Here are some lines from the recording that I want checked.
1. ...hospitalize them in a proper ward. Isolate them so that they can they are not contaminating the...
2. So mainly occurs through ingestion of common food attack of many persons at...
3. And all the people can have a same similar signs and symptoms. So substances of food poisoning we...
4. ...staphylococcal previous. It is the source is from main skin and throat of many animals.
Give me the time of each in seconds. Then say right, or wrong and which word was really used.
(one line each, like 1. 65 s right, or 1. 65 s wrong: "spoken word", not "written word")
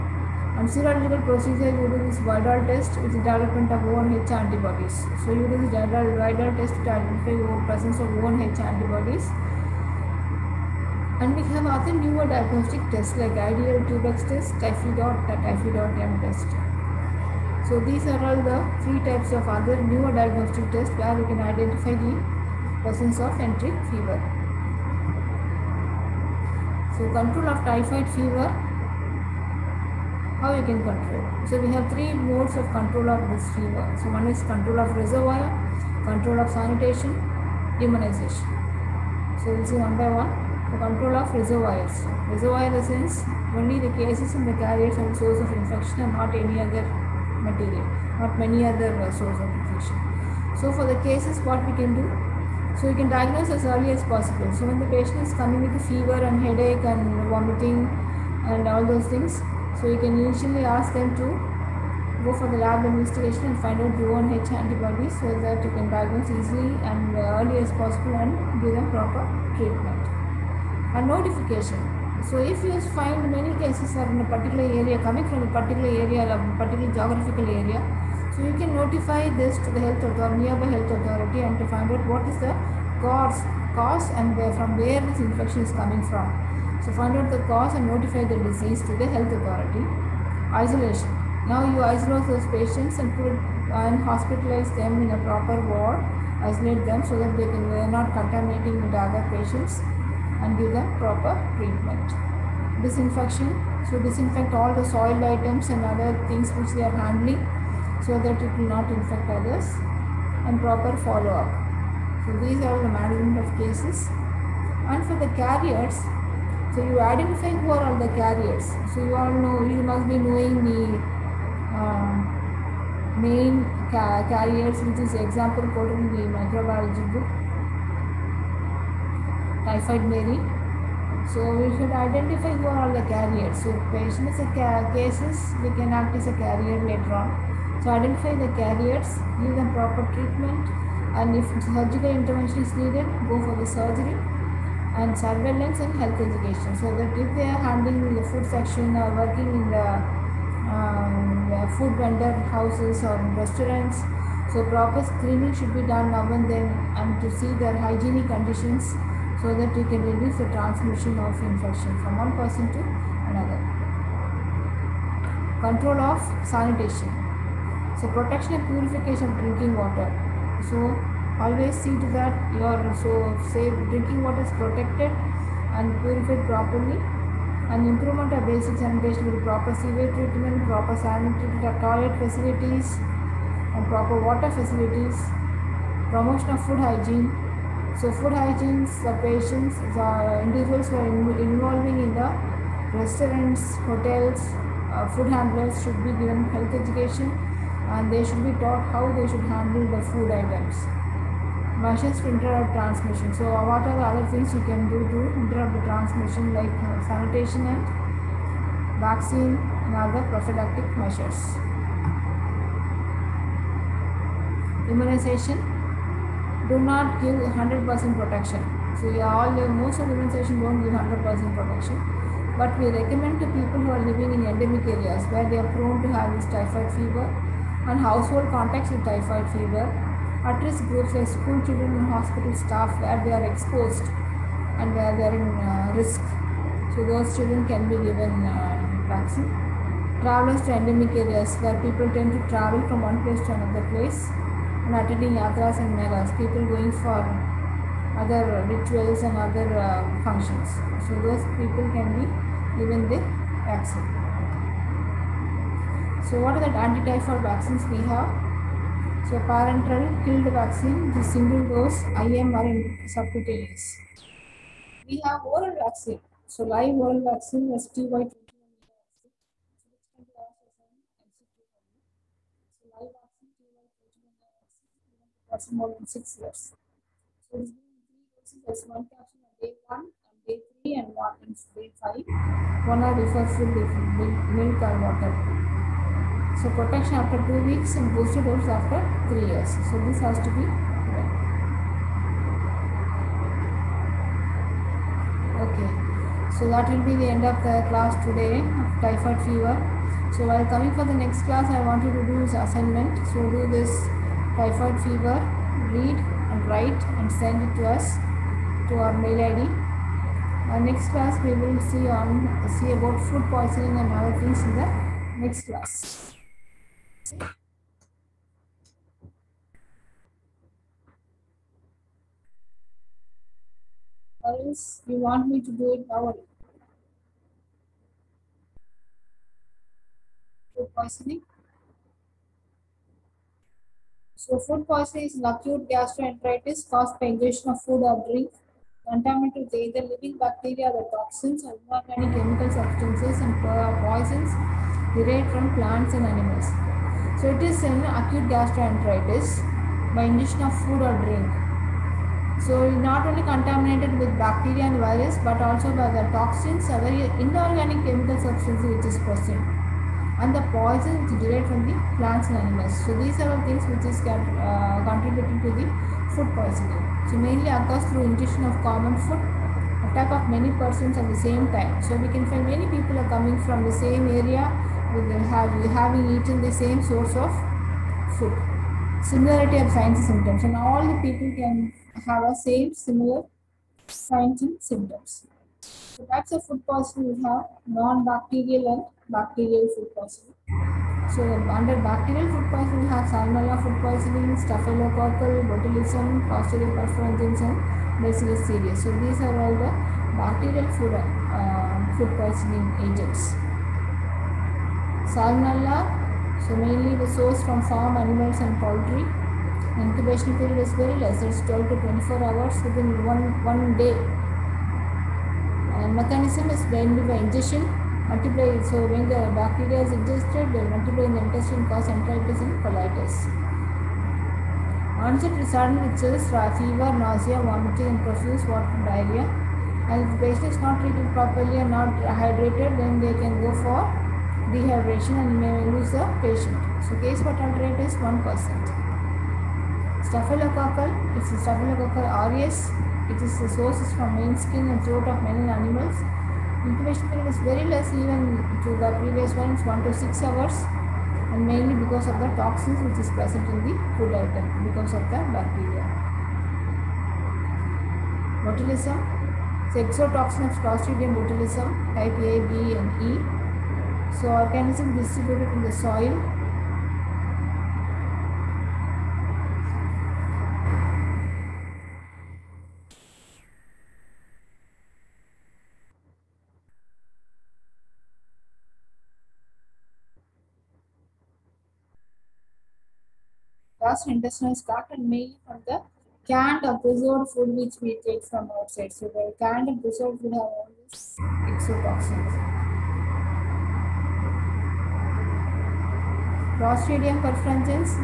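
1. 94 s right
2. 367 s right
3. 380 s wrong: "types", not "substances"
4. 441 s wrong: "aureus", not "previous".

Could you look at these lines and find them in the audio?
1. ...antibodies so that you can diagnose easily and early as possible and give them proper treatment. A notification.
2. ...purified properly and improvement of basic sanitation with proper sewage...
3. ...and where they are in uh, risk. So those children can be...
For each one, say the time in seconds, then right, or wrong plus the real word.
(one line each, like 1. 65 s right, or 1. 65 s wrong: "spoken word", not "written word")
1. 64 s right
2. 176 s right
3. 234 s right.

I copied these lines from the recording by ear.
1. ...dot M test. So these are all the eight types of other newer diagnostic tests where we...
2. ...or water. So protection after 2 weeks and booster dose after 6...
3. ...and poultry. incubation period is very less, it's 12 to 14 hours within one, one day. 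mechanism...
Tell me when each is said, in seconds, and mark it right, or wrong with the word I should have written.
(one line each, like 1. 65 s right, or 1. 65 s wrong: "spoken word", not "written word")
1. 14 s wrong: "three", not "eight"
2. 284 s wrong: "3", not "6"
3. 408 s wrong: "24", not "14".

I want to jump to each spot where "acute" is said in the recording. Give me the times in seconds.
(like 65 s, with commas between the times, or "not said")
335 s, 348 s.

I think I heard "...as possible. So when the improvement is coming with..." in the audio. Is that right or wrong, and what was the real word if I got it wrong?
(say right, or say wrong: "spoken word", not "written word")
wrong: "patient", not "improvement".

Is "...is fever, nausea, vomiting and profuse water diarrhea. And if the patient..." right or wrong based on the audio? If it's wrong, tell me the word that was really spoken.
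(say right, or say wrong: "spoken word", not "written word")
right.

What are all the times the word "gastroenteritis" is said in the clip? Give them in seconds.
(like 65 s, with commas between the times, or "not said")
335 s, 348 s.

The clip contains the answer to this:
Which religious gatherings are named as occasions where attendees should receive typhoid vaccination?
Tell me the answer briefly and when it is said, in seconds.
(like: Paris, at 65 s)
yatras and melas, at 245 s.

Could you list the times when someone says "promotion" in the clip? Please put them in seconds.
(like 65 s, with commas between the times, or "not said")
186 s.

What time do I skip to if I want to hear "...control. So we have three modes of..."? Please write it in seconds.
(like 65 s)
30 s.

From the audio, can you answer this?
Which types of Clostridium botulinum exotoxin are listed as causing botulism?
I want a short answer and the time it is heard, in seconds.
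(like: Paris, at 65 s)
A, B and E, at 462 s.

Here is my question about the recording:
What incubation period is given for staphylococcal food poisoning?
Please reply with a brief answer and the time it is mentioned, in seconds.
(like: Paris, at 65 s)
1 to 6 hours, at 449 s.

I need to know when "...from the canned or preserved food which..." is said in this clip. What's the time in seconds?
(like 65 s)
485 s.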